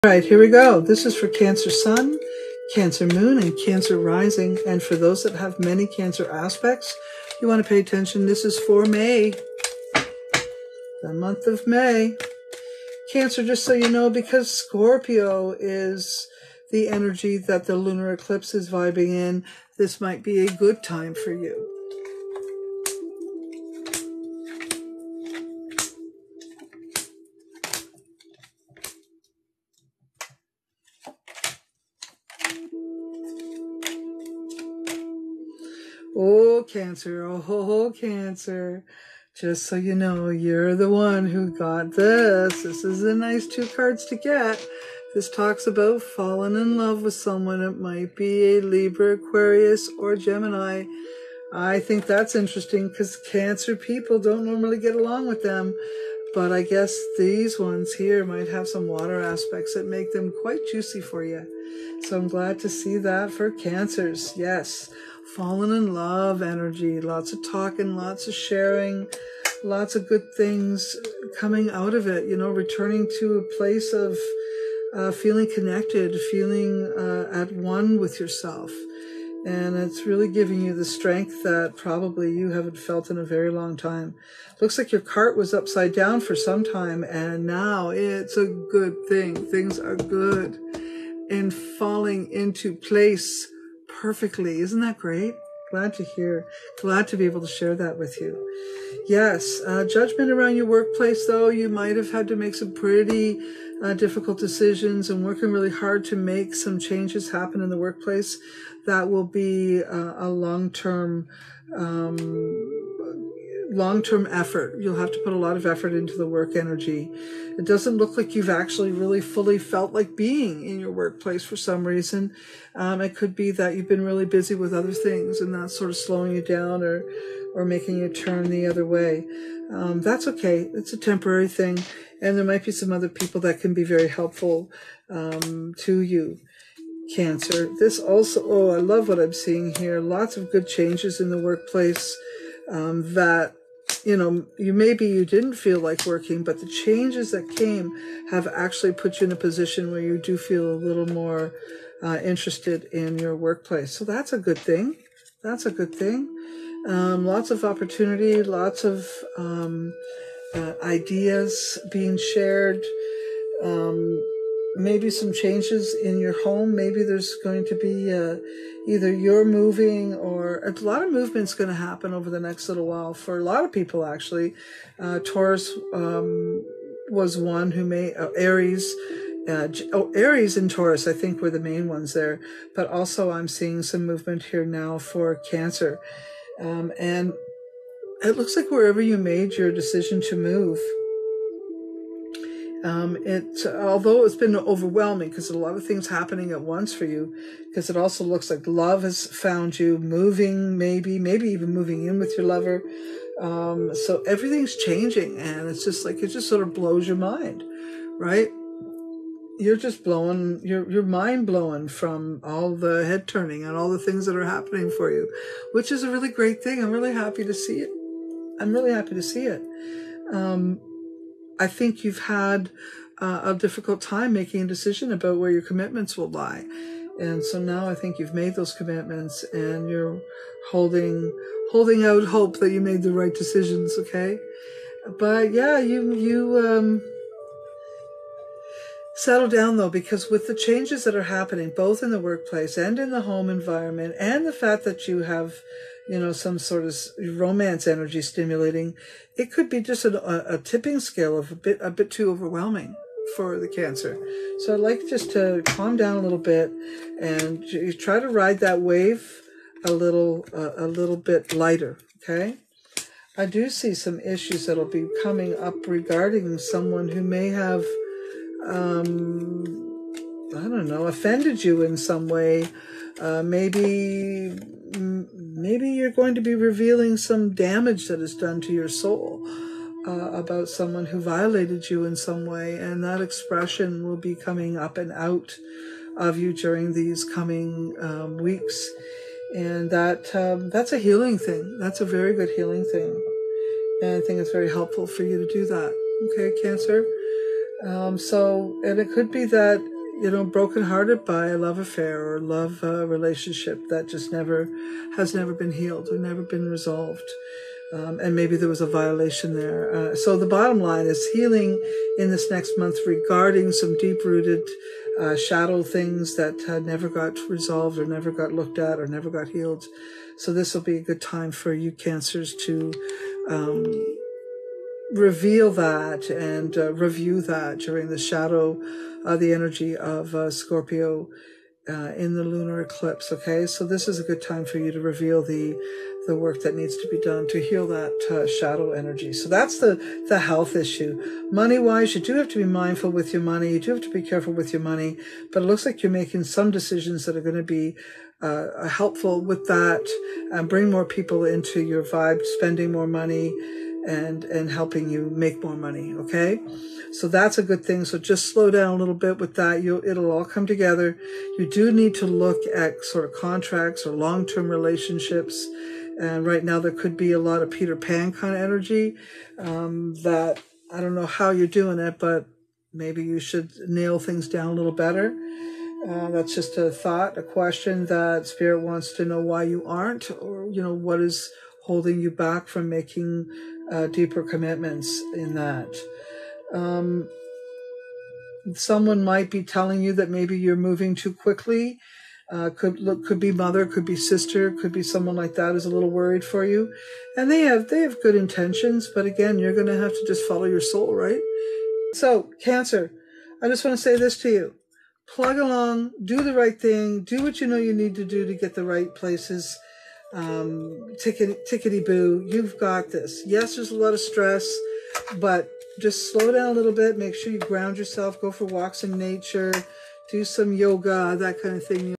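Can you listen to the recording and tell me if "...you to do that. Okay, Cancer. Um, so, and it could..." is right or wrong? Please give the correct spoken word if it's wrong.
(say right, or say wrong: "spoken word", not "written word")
right.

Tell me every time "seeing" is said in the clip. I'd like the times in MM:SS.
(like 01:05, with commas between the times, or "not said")
02:19, 03:03.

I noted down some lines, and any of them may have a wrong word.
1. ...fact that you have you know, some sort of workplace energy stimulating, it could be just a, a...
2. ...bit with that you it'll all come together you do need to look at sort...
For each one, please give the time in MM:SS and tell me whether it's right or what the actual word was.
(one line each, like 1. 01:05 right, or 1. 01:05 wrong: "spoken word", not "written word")
1. 04:04 wrong: "romance", not "workplace"
2. 05:59 right.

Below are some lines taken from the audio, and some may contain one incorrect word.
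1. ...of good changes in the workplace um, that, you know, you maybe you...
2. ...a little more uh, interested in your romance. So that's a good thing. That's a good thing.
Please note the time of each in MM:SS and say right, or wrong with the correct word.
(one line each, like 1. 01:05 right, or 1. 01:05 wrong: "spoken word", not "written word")
1. 02:20 right
2. 02:30 wrong: "workplace", not "romance".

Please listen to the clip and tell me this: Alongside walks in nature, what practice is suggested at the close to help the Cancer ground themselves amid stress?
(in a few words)
Yoga.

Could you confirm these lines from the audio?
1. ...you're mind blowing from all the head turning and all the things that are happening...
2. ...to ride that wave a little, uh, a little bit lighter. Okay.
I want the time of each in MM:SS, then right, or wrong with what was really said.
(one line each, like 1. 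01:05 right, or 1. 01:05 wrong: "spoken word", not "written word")
1. 03:30 right
2. 04:18 right.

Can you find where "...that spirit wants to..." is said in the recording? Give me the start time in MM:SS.
06:18.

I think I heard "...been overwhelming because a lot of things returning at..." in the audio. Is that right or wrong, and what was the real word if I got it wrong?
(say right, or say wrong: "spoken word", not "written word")
wrong: "happening", not "returning".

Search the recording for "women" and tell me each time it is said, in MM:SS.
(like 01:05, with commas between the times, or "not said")
not said.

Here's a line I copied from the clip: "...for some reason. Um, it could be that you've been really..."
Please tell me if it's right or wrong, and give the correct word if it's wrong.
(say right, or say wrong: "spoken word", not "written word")
right.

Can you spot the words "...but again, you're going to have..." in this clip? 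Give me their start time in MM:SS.
06:39.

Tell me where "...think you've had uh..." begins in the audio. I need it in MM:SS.
03:41.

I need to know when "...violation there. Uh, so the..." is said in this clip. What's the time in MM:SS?
05:08.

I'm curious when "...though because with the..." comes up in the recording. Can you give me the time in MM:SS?
03:59.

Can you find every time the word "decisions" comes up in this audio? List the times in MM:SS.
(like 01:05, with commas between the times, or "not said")
01:44, 03:09, 03:44, 03:53, 05:46.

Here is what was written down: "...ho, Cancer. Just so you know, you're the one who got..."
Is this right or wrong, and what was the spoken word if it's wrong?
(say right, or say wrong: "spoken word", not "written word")
right.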